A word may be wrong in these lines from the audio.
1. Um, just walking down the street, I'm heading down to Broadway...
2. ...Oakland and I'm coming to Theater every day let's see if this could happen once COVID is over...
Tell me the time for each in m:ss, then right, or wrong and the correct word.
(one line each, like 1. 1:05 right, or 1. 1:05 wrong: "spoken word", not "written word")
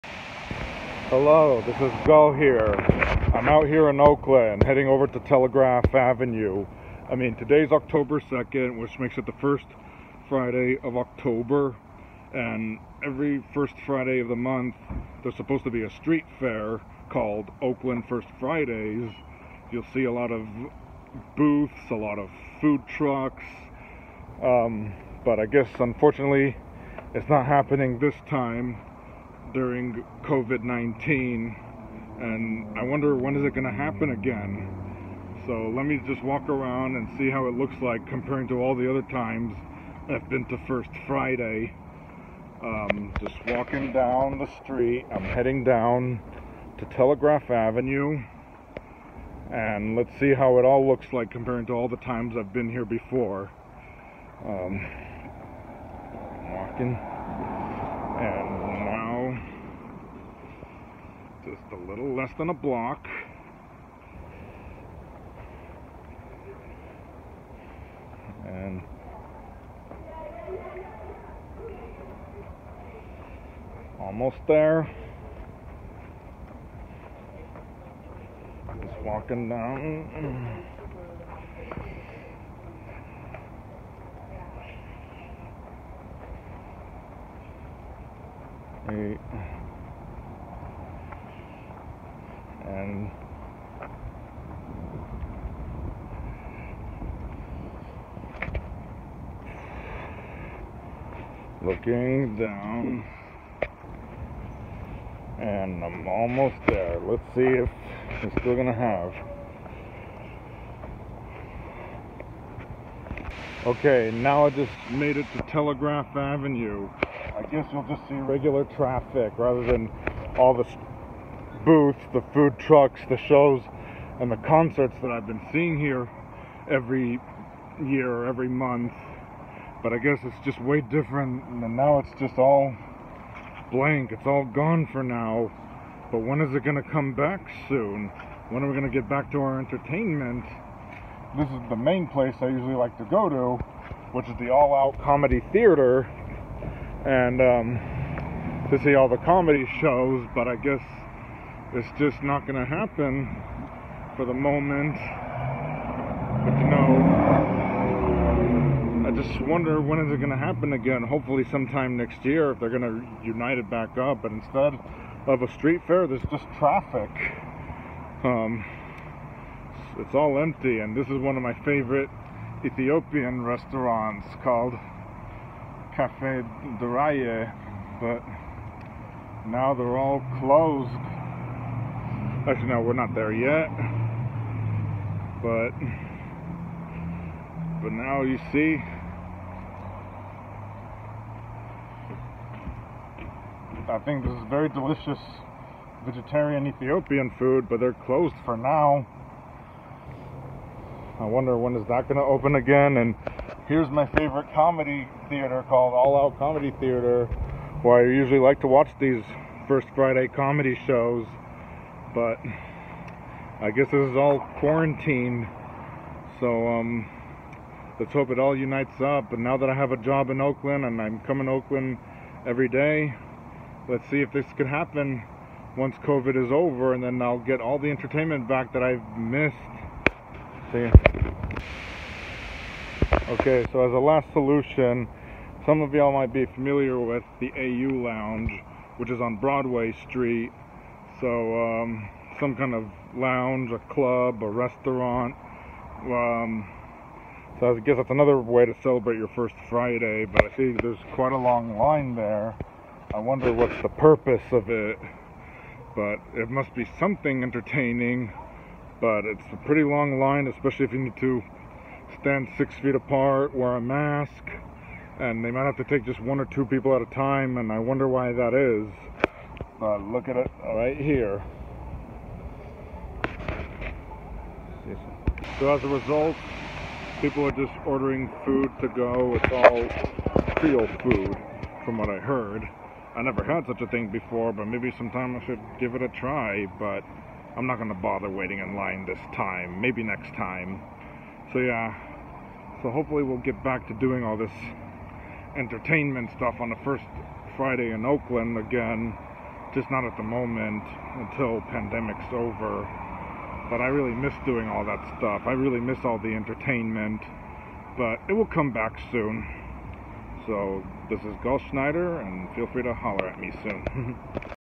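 1. 0:42 wrong: "Telegraph", not "Broadway"
2. 3:40 wrong: "Oakland", not "Theater".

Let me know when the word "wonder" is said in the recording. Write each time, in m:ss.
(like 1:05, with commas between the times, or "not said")
0:32, 2:39, 3:21, 4:13, 4:27.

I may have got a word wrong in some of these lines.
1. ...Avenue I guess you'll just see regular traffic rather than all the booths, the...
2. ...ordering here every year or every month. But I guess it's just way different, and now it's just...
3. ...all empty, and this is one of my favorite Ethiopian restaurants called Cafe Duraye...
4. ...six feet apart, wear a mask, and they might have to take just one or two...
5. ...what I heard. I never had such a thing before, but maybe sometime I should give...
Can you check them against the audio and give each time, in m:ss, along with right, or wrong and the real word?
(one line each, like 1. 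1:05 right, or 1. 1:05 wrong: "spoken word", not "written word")
1. 1:56 right
2. 2:05 wrong: "seeing", not "ordering"
3. 2:50 right
4. 4:22 right
5. 4:41 right.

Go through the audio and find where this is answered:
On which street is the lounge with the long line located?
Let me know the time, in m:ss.
3:59.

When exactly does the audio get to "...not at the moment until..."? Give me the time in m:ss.
4:59.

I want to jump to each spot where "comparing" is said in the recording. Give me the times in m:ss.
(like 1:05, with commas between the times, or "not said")
0:38, 0:51.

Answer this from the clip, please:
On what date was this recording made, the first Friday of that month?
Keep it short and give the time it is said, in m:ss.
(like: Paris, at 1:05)
October 2nd, at 0:07.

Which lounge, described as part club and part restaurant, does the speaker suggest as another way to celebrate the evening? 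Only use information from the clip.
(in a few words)
AU Lounge.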